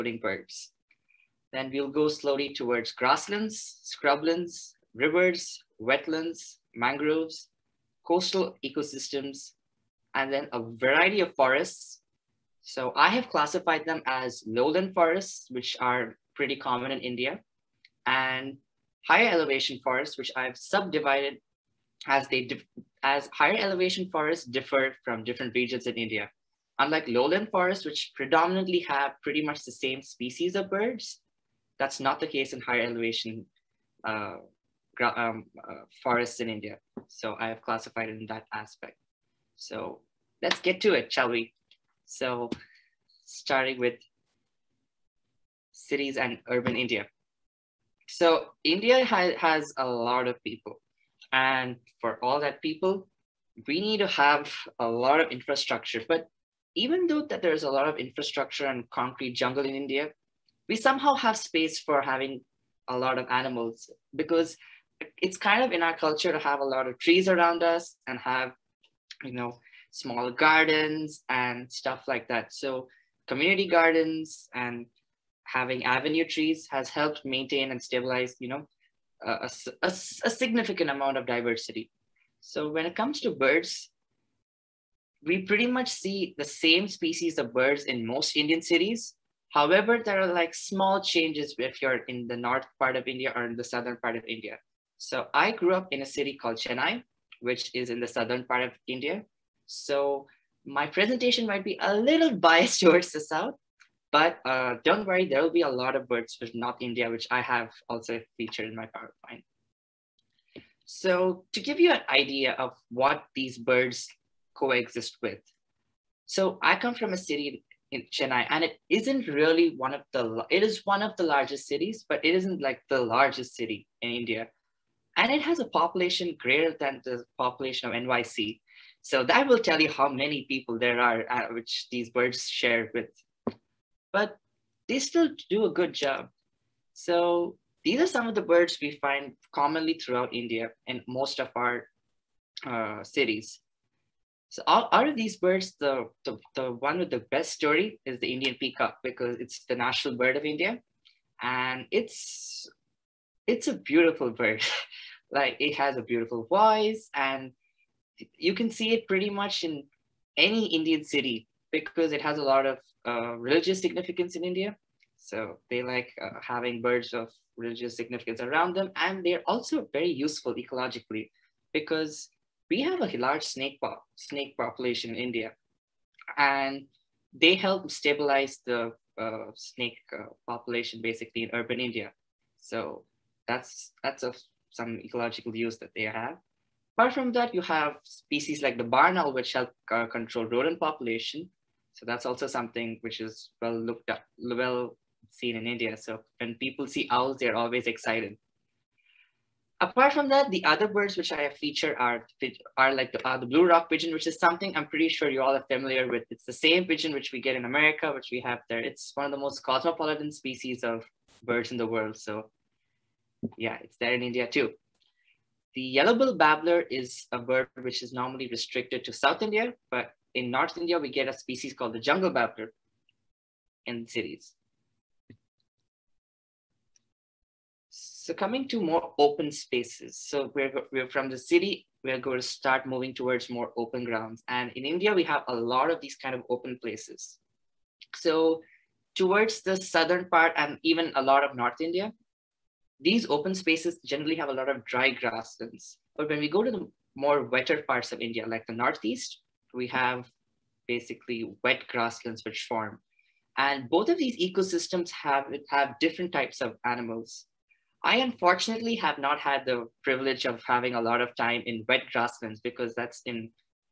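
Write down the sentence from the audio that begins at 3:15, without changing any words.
So when people see owls, they're always excited.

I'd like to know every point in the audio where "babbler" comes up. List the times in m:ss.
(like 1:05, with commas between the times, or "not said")
3:36, 3:42.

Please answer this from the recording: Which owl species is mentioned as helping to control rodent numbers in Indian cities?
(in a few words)
Barn owl.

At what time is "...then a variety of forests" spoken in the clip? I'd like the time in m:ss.
0:10.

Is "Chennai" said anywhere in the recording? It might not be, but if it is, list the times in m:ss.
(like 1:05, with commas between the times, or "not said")
1:36, 1:58.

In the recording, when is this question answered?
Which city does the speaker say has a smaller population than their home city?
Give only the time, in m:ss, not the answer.
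2:07.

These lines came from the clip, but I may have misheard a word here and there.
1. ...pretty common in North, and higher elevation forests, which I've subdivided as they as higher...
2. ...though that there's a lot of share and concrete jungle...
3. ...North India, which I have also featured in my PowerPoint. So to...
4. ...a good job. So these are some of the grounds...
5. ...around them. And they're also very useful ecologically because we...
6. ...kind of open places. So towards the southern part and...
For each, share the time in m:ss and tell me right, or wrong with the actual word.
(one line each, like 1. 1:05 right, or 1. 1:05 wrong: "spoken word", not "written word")
1. 0:16 wrong: "India", not "North"
2. 0:57 wrong: "infrastructure", not "share"
3. 1:46 right
4. 2:15 wrong: "birds", not "grounds"
5. 2:48 right
6. 3:56 right.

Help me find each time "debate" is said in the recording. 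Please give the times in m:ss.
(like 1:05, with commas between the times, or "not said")
not said.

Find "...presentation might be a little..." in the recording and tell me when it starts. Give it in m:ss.
1:40.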